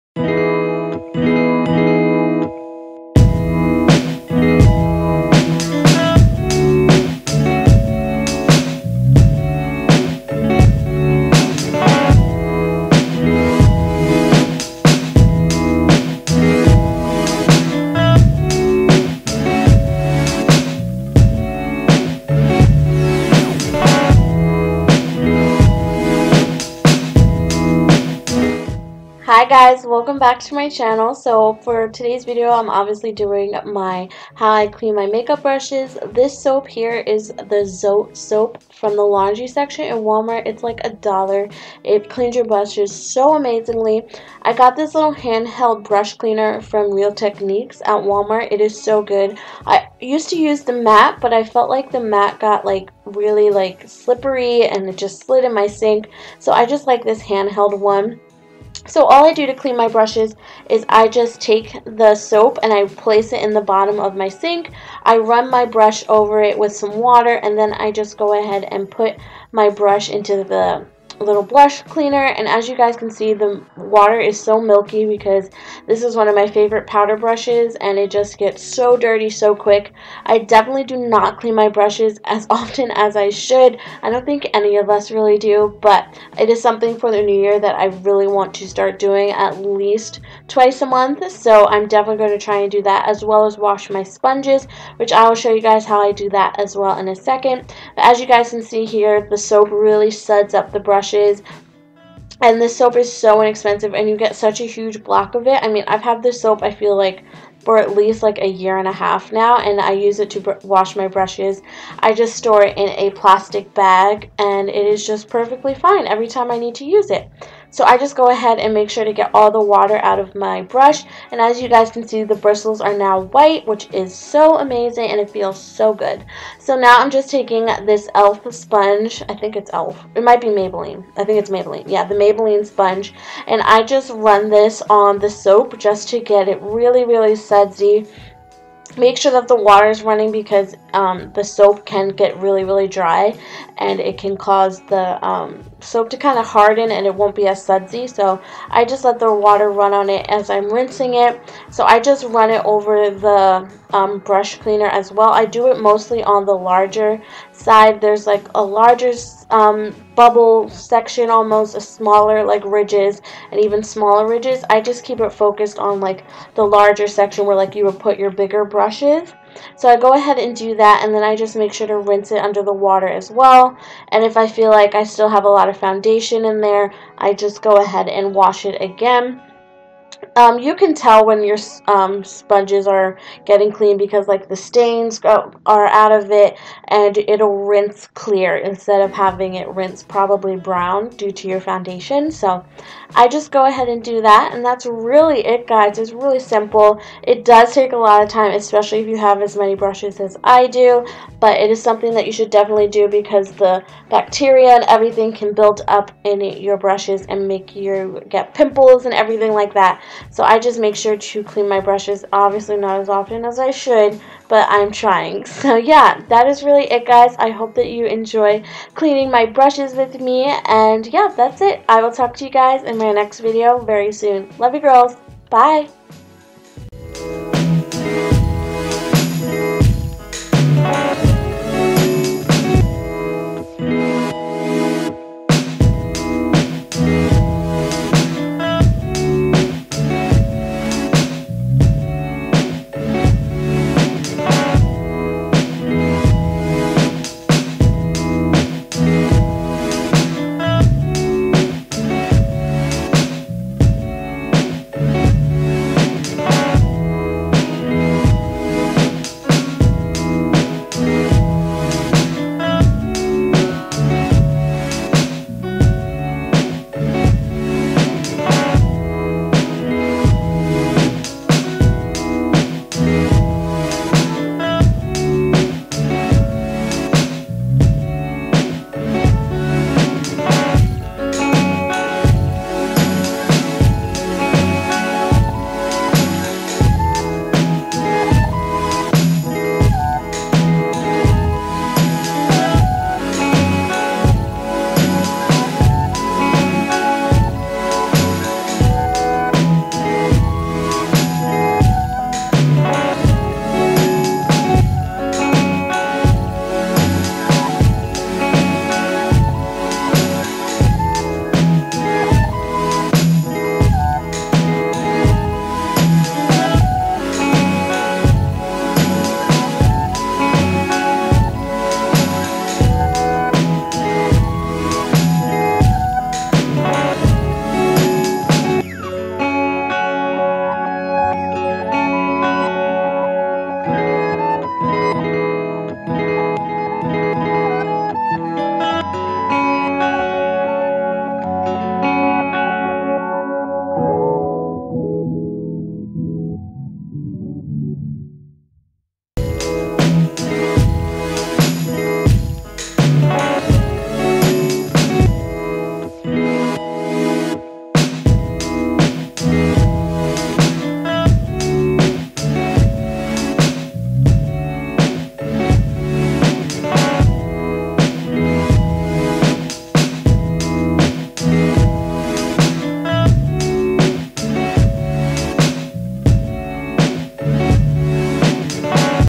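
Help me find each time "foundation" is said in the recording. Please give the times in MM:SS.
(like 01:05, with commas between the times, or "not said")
02:55, 03:11.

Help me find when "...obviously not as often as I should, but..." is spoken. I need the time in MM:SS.
03:32.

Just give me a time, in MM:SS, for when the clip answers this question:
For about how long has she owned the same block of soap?
01:48.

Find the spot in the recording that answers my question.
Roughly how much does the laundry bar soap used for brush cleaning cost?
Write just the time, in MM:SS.
00:40.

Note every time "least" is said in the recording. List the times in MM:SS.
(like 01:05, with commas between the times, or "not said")
01:29, 01:47.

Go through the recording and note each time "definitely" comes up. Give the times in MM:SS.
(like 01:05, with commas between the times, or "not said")
01:20, 01:31, 03:22.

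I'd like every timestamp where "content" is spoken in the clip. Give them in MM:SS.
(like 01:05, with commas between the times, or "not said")
not said.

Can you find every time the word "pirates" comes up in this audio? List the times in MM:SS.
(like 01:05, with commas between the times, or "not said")
not said.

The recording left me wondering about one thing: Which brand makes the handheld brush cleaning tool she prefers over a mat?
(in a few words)
Real Techniques.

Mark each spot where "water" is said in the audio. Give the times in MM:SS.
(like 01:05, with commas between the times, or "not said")
01:06, 01:13, 01:59, 02:19, 02:29, 02:52.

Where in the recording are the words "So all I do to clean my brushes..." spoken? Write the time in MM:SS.
00:58.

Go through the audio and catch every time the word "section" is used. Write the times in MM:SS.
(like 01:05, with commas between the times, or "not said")
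00:39, 02:40, 02:47.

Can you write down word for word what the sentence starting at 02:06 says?
So now I'm just taking this e.l.f.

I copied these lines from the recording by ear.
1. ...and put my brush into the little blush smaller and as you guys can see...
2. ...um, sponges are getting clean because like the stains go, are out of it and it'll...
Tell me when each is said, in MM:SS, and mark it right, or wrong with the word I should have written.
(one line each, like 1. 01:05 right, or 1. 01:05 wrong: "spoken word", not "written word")
1. 01:08 wrong: "cleaner", not "smaller"
2. 03:01 right.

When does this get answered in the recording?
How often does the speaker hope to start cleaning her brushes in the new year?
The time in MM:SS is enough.
01:30.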